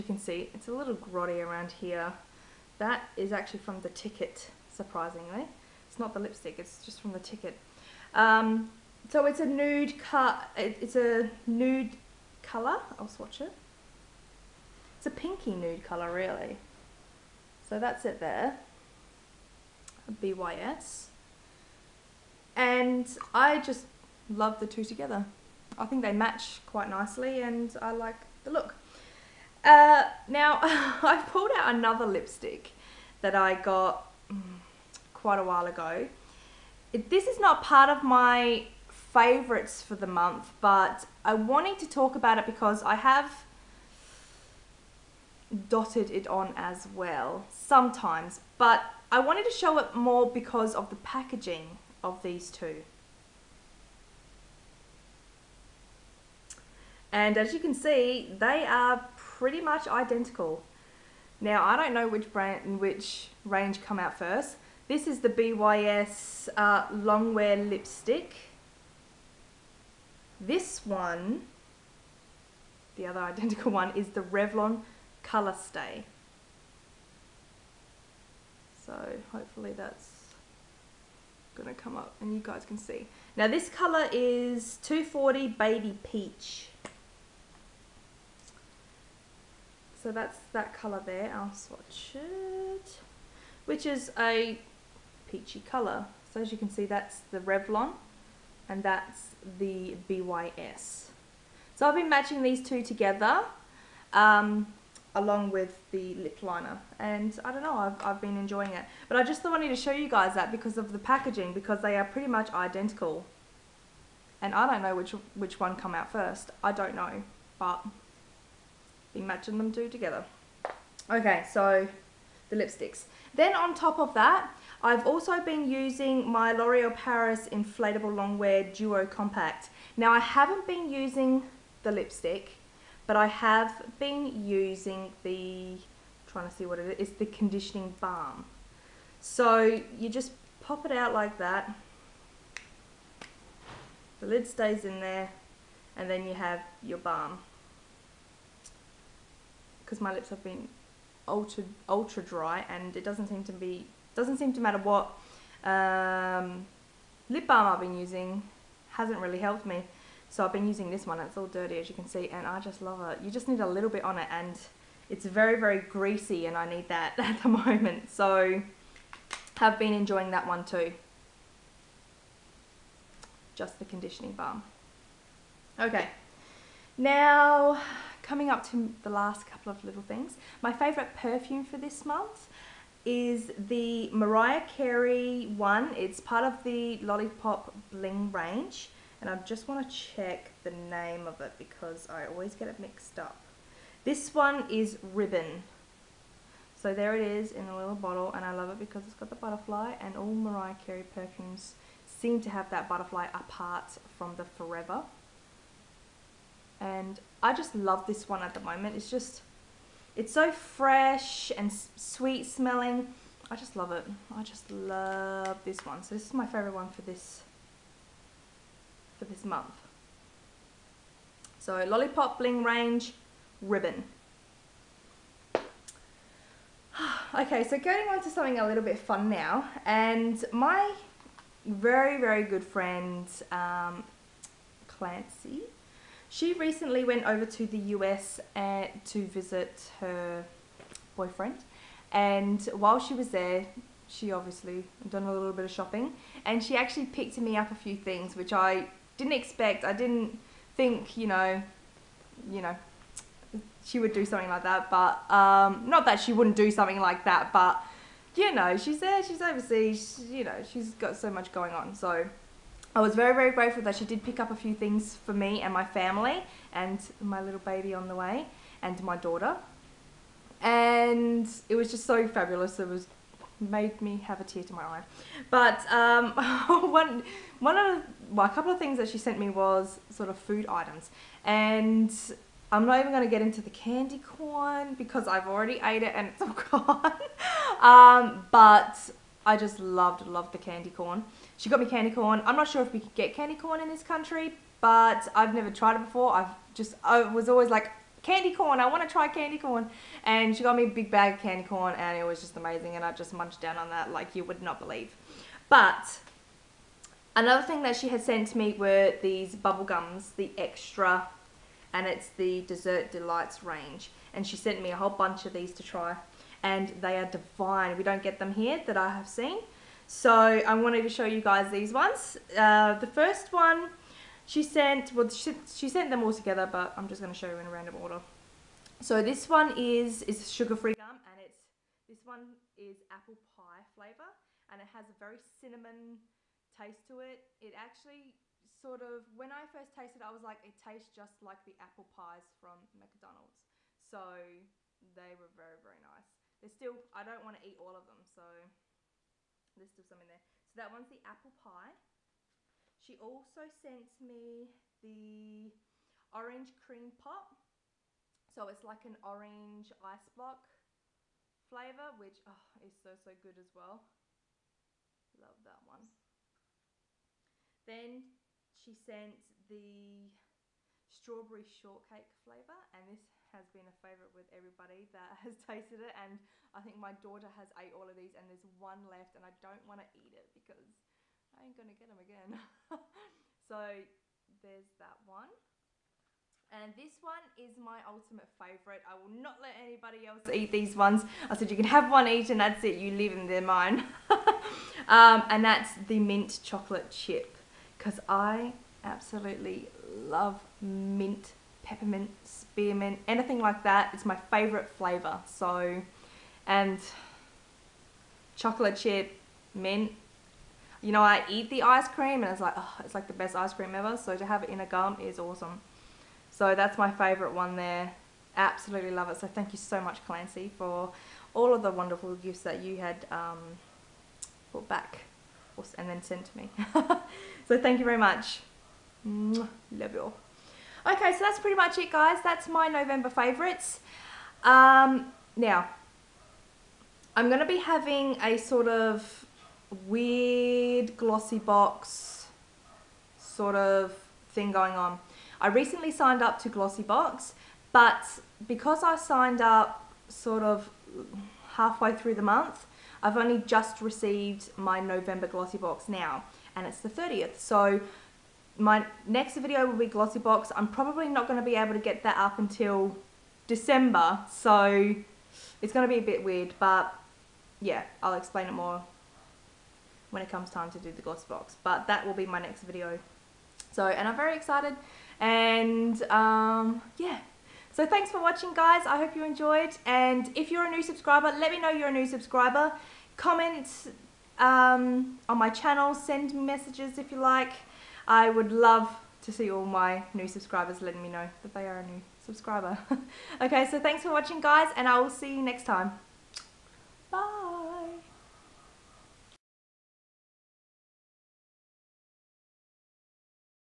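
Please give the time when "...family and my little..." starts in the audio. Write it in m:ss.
4:25.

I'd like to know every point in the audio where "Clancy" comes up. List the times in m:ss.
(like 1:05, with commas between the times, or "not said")
3:54, 7:00.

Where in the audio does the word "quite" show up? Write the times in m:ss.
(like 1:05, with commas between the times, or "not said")
0:26, 0:35.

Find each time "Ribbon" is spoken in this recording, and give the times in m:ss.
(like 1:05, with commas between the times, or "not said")
3:15, 3:43.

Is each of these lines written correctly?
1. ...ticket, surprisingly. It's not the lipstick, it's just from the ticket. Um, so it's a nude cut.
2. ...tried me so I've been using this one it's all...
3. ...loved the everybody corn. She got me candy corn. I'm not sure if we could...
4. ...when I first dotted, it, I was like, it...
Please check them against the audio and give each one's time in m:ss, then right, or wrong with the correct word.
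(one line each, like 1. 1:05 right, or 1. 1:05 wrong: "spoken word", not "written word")
1. 0:03 right
2. 2:39 wrong: "helped", not "tried"
3. 4:50 wrong: "candy", not "everybody"
4. 5:39 wrong: "tasted", not "dotted".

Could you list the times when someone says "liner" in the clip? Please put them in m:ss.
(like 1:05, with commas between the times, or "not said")
1:46.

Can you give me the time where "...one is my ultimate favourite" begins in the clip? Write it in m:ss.
6:27.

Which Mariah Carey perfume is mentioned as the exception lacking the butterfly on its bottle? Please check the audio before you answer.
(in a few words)
Forever.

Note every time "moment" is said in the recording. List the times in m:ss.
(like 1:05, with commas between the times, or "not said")
2:47, 3:28.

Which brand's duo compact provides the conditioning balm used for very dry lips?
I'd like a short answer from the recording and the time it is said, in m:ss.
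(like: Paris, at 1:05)
L'Oreal Paris, at 2:06.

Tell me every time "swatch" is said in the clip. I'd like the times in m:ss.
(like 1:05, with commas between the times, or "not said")
0:13, 1:31.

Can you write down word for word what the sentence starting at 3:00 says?
My favourite perfume for this month is the Mariah Carey one.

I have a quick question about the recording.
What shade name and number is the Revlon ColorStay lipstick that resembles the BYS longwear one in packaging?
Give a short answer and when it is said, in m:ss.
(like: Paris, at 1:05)
240 Baby Peach, at 1:24.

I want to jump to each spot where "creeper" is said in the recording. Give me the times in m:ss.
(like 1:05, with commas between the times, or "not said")
not said.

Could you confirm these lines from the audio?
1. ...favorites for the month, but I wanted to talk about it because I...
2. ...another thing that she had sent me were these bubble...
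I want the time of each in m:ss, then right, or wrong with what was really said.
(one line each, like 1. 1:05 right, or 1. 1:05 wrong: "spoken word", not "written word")
1. 0:38 right
2. 5:07 right.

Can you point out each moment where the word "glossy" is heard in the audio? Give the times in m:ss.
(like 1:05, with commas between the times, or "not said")
7:21, 7:26, 7:35, 7:40, 7:51.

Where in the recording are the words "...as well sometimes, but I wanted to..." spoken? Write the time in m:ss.
0:46.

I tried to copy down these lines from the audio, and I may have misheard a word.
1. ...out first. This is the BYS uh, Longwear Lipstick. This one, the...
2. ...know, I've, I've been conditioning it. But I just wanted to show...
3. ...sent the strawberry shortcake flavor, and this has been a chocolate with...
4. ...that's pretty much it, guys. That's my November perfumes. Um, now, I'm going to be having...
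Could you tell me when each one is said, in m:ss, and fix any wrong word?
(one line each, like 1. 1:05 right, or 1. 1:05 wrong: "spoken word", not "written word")
1. 1:03 right
2. 1:47 wrong: "enjoying", not "conditioning"
3. 6:08 wrong: "favourite", not "chocolate"
4. 7:11 wrong: "favourites", not "perfumes".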